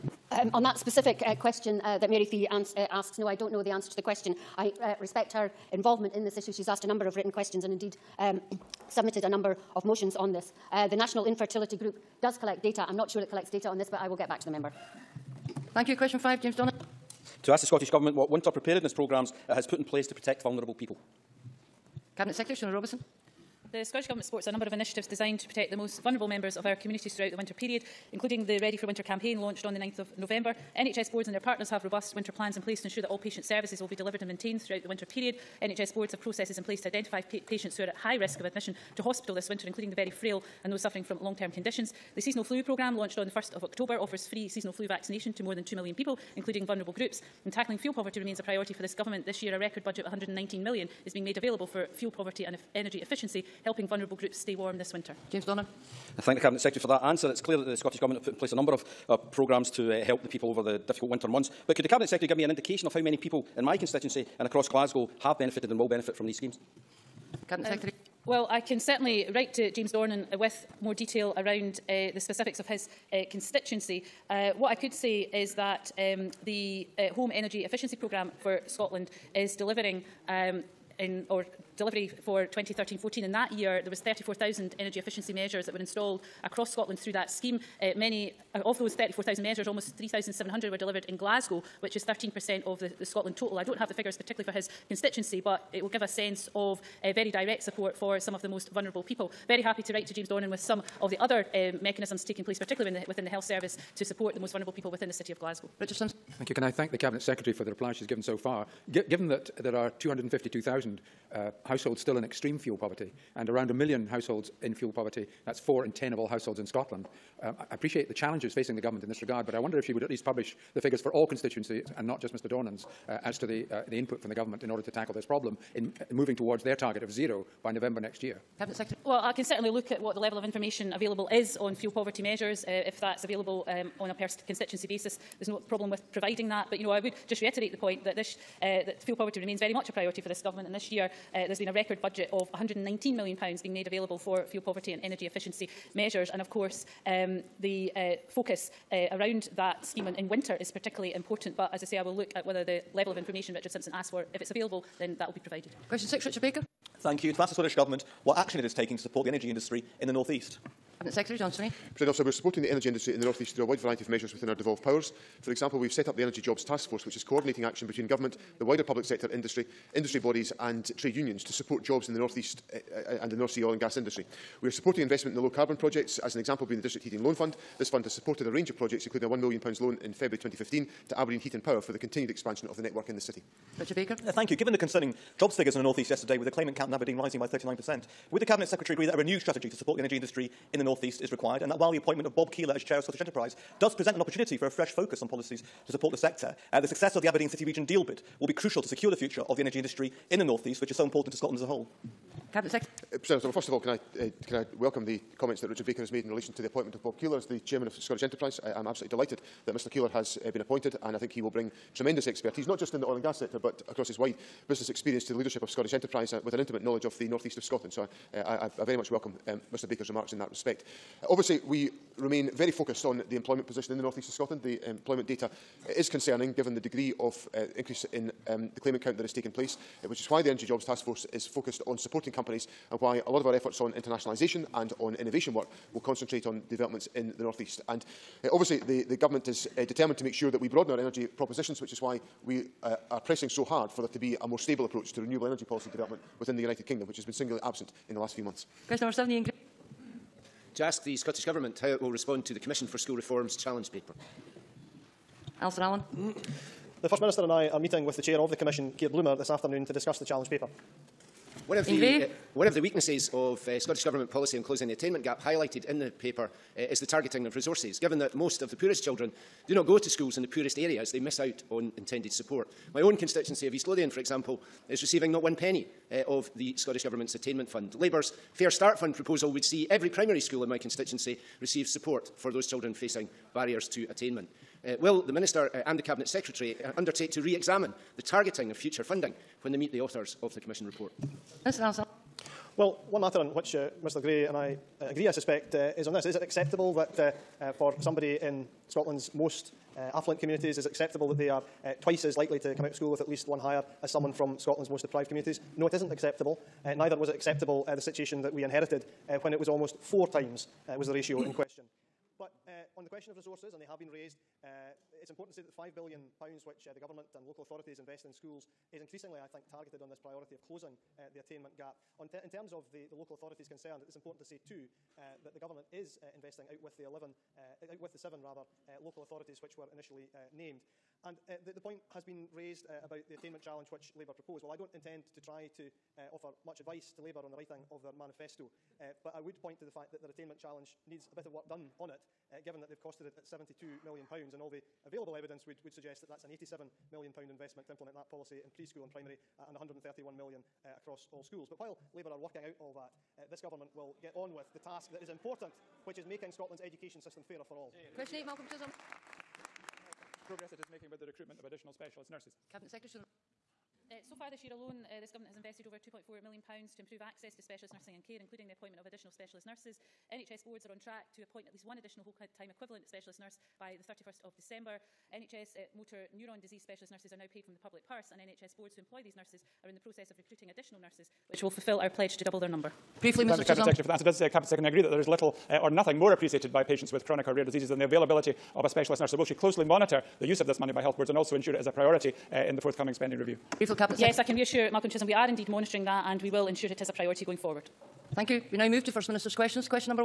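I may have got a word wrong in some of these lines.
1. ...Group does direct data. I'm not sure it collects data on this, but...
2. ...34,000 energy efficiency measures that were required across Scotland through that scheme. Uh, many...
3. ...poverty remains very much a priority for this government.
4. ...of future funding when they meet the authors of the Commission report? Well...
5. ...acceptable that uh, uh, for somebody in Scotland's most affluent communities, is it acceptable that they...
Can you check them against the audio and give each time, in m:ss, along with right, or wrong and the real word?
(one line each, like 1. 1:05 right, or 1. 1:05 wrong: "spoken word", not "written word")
1. 0:11 wrong: "collect", not "direct"
2. 1:23 wrong: "installed", not "required"
3. 2:19 right
4. 4:48 right
5. 4:56 right.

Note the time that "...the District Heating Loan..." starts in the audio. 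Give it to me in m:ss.
2:56.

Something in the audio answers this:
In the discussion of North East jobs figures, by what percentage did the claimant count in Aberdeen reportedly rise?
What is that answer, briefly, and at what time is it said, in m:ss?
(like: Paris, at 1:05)
39%, at 3:07.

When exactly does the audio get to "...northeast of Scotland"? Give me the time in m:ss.
3:37.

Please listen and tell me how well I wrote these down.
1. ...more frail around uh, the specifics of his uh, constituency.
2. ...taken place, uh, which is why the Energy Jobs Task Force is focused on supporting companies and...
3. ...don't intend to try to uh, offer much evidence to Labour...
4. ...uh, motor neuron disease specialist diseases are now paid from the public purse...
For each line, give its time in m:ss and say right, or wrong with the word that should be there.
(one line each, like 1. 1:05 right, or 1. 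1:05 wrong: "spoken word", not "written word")
1. 1:10 wrong: "detail", not "frail"
2. 3:49 right
3. 5:34 wrong: "advice", not "evidence"
4. 6:15 wrong: "nurses", not "diseases".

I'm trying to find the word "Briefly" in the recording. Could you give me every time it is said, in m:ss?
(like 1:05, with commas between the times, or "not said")
6:23, 6:33.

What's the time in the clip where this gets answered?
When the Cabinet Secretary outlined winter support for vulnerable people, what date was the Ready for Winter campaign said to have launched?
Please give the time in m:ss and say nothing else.
0:29.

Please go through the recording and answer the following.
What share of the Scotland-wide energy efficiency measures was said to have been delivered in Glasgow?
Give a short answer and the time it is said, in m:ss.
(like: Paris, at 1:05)
13%, at 1:32.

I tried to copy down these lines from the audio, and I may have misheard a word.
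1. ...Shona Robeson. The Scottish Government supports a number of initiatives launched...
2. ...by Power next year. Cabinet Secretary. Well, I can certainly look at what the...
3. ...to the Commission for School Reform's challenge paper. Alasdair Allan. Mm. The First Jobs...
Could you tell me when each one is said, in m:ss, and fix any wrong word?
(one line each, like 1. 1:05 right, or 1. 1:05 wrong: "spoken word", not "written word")
1. 0:22 wrong: "designed", not "launched"
2. 2:07 wrong: "November", not "Power"
3. 4:12 wrong: "Minister", not "Jobs".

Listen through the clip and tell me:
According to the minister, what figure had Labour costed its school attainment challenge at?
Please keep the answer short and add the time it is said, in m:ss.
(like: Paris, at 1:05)
£72 million, at 5:43.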